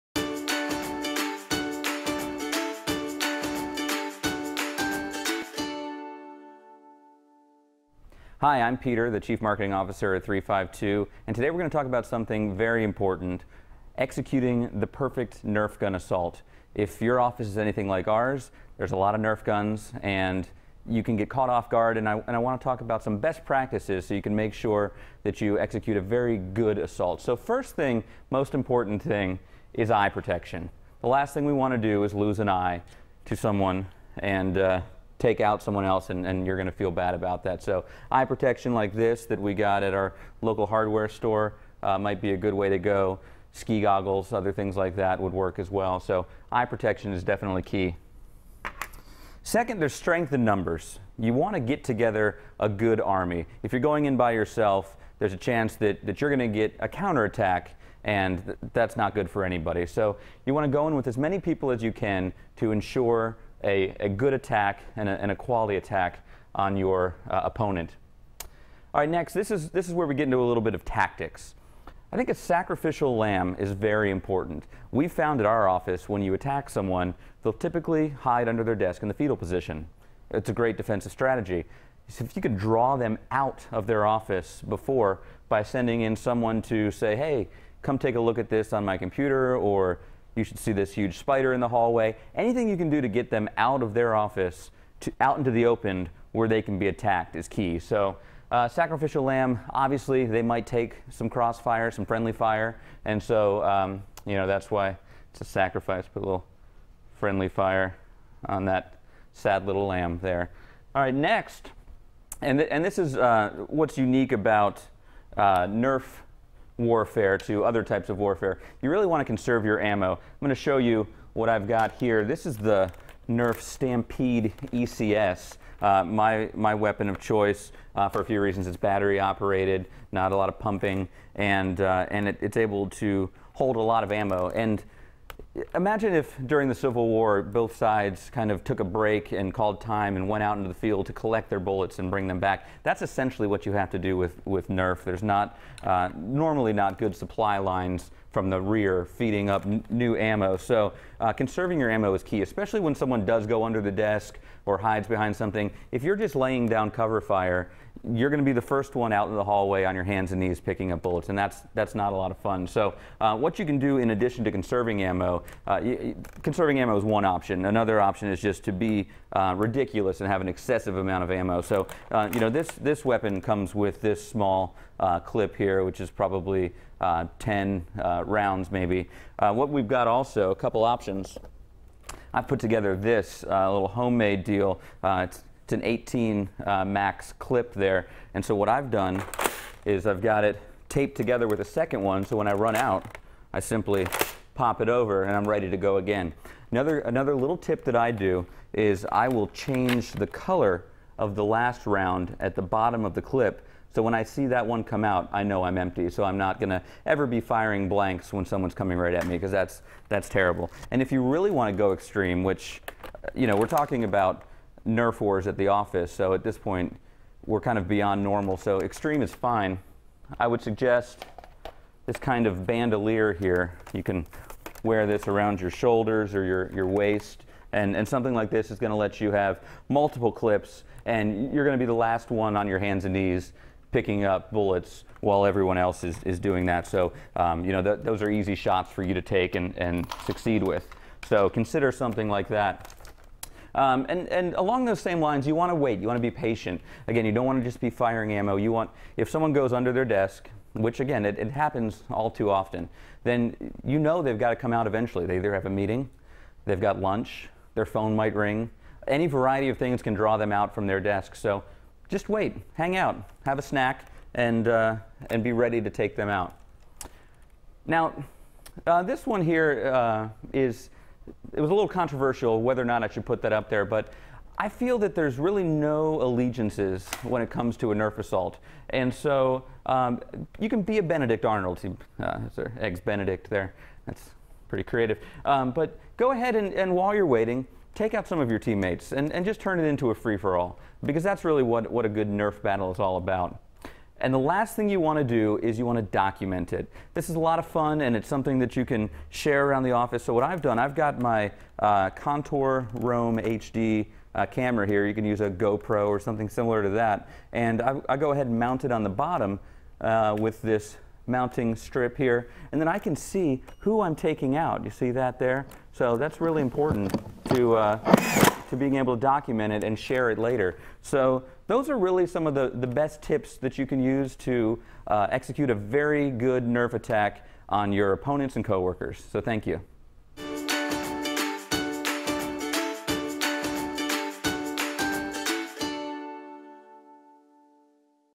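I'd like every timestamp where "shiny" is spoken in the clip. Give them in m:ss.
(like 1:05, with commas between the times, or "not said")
not said.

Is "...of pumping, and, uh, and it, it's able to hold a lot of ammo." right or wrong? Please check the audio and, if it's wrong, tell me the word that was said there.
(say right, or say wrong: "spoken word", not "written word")
right.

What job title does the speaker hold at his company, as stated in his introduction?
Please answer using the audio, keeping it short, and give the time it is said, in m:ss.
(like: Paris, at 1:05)
Chief Marketing Officer, at 0:09.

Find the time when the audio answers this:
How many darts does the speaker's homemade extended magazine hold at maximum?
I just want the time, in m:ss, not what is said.
3:05.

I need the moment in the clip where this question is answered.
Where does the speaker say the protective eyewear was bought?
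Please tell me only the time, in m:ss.
0:40.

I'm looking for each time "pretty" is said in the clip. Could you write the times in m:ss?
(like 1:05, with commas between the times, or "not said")
4:44.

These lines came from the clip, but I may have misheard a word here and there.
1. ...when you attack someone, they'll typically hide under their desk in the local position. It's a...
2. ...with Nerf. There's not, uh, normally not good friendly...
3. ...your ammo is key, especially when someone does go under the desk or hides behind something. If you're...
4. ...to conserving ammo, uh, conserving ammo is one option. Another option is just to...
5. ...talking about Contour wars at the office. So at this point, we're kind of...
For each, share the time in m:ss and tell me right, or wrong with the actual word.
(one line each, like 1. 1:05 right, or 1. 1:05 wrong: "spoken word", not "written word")
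1. 1:16 wrong: "fetal", not "local"
2. 2:24 wrong: "supply", not "friendly"
3. 2:31 right
4. 2:44 right
5. 3:33 wrong: "Nerf", not "Contour".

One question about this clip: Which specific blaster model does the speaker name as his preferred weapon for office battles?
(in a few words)
Nerf Stampede ECS.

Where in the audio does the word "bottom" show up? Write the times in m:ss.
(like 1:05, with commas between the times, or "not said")
3:22, 5:09.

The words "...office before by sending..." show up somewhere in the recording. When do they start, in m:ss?
1:24.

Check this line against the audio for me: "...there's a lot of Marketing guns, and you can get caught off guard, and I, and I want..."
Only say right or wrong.
wrong.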